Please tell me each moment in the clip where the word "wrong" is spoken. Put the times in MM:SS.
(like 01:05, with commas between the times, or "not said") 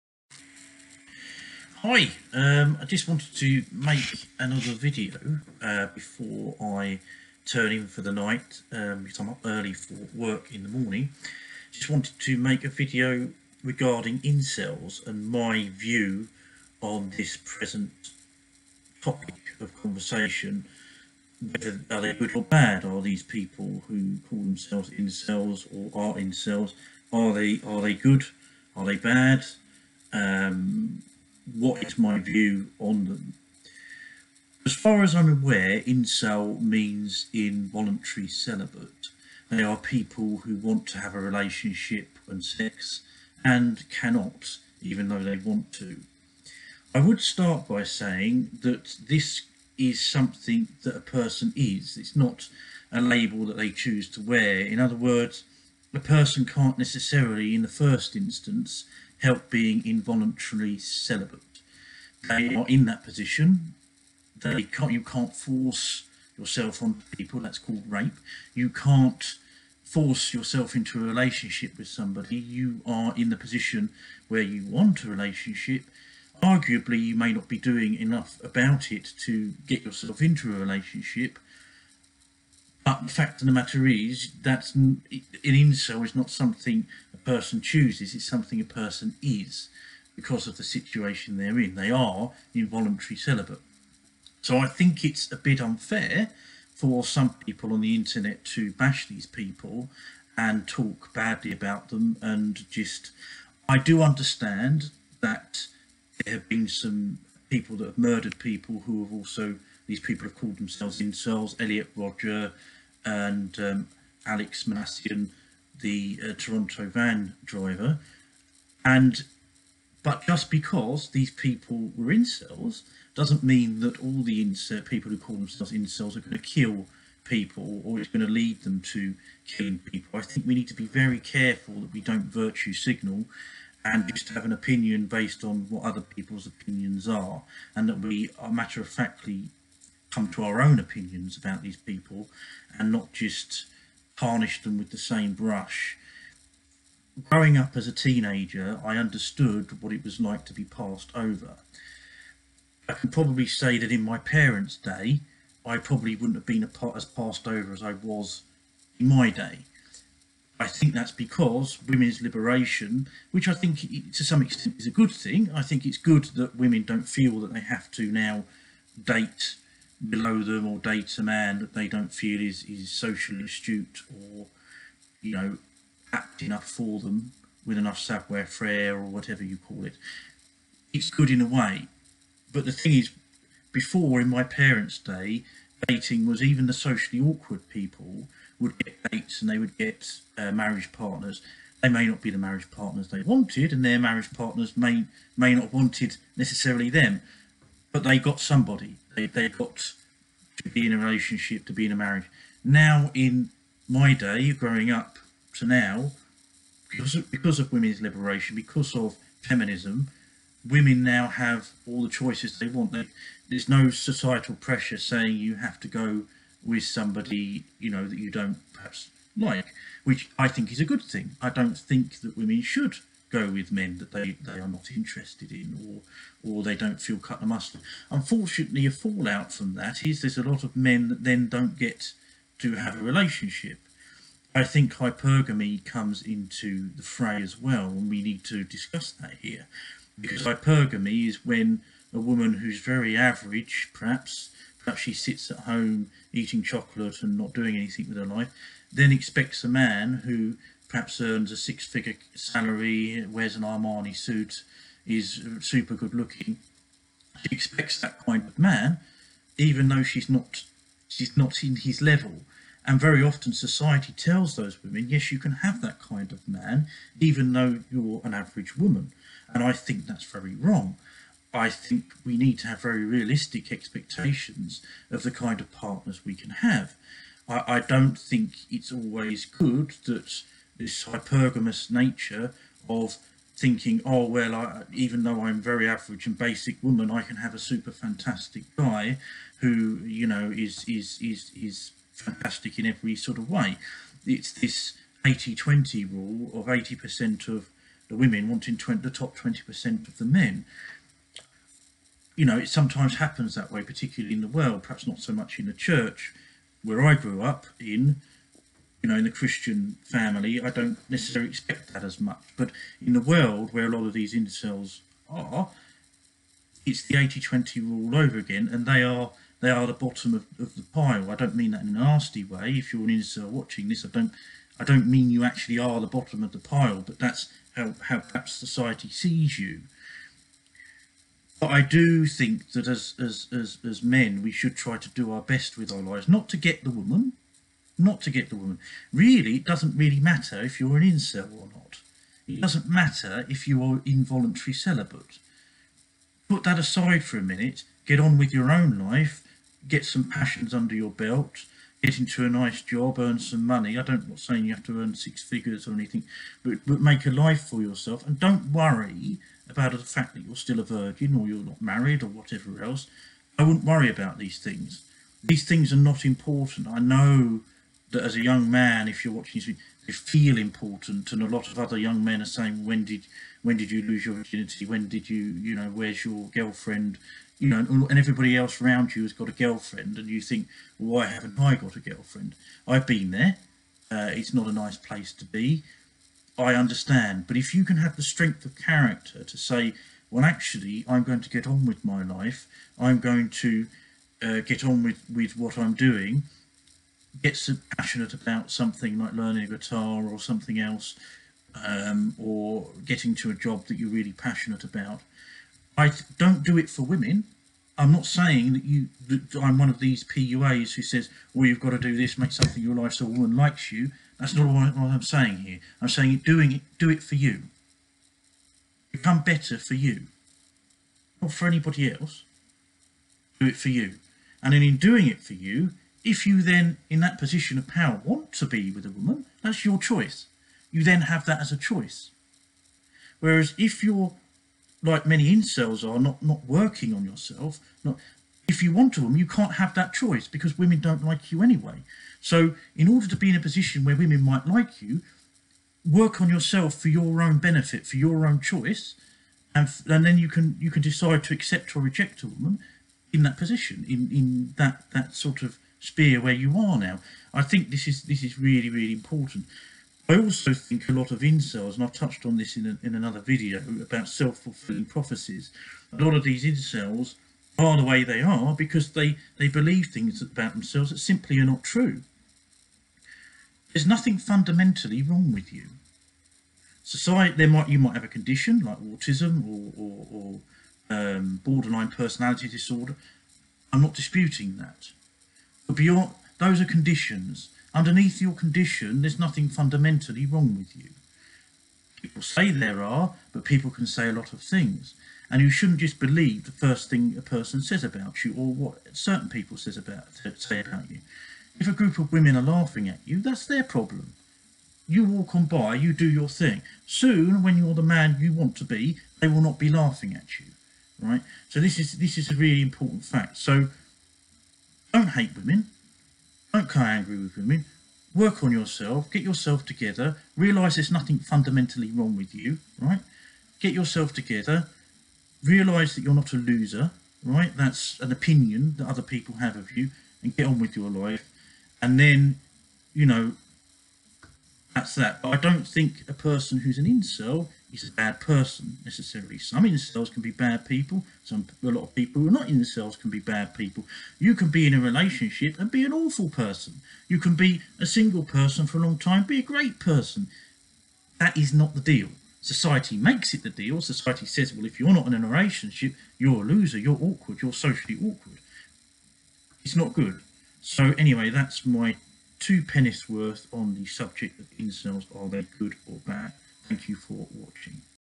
04:30, 07:55, 08:10, 08:42.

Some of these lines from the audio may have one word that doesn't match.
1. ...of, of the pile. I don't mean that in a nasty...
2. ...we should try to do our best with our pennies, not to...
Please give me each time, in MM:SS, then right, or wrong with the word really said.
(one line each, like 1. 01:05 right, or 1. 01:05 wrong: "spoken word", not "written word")
1. 05:20 right
2. 05:34 wrong: "lives", not "pennies".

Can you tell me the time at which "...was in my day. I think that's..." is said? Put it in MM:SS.
02:37.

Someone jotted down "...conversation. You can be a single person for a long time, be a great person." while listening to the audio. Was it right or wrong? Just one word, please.
wrong.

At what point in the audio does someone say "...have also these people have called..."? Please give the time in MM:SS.
01:49.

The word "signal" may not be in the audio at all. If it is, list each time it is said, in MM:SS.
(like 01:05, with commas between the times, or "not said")
02:12.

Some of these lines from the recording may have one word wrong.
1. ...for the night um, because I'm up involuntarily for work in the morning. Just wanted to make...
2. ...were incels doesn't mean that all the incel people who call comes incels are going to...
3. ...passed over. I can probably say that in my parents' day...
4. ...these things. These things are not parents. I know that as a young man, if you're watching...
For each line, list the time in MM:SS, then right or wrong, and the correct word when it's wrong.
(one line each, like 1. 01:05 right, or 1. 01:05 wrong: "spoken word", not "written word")
1. 00:07 wrong: "early", not "involuntarily"
2. 02:01 wrong: "themselves", not "comes"
3. 02:30 right
4. 06:04 wrong: "important", not "parents".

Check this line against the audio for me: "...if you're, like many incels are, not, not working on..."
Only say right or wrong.
right.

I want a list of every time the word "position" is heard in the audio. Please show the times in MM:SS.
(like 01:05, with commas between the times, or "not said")
01:03, 01:13, 07:07, 07:23, 07:33.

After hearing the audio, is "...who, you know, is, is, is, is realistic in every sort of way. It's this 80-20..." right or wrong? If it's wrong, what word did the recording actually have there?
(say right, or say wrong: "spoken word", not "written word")
wrong: "fantastic", not "realistic".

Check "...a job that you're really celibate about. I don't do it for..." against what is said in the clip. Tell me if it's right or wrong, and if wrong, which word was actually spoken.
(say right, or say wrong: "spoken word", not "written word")
wrong: "passionate", not "celibate".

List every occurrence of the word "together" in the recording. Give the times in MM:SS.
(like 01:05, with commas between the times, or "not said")
08:39, 08:44.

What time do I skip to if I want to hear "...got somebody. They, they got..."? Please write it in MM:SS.
03:18.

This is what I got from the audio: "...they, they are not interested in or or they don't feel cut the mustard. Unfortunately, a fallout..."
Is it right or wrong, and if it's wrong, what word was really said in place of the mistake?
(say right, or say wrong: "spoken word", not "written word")
right.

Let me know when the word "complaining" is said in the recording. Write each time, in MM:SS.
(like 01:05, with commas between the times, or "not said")
not said.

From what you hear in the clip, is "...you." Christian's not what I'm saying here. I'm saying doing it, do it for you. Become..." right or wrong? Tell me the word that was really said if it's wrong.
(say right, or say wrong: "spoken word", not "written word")
wrong: "That", not "Christian".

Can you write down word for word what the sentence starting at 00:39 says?
They are people who want to have a relationship and sex and cannot, even though they want to.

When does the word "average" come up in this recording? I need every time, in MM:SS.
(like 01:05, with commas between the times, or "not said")
04:03, 04:28, 04:45.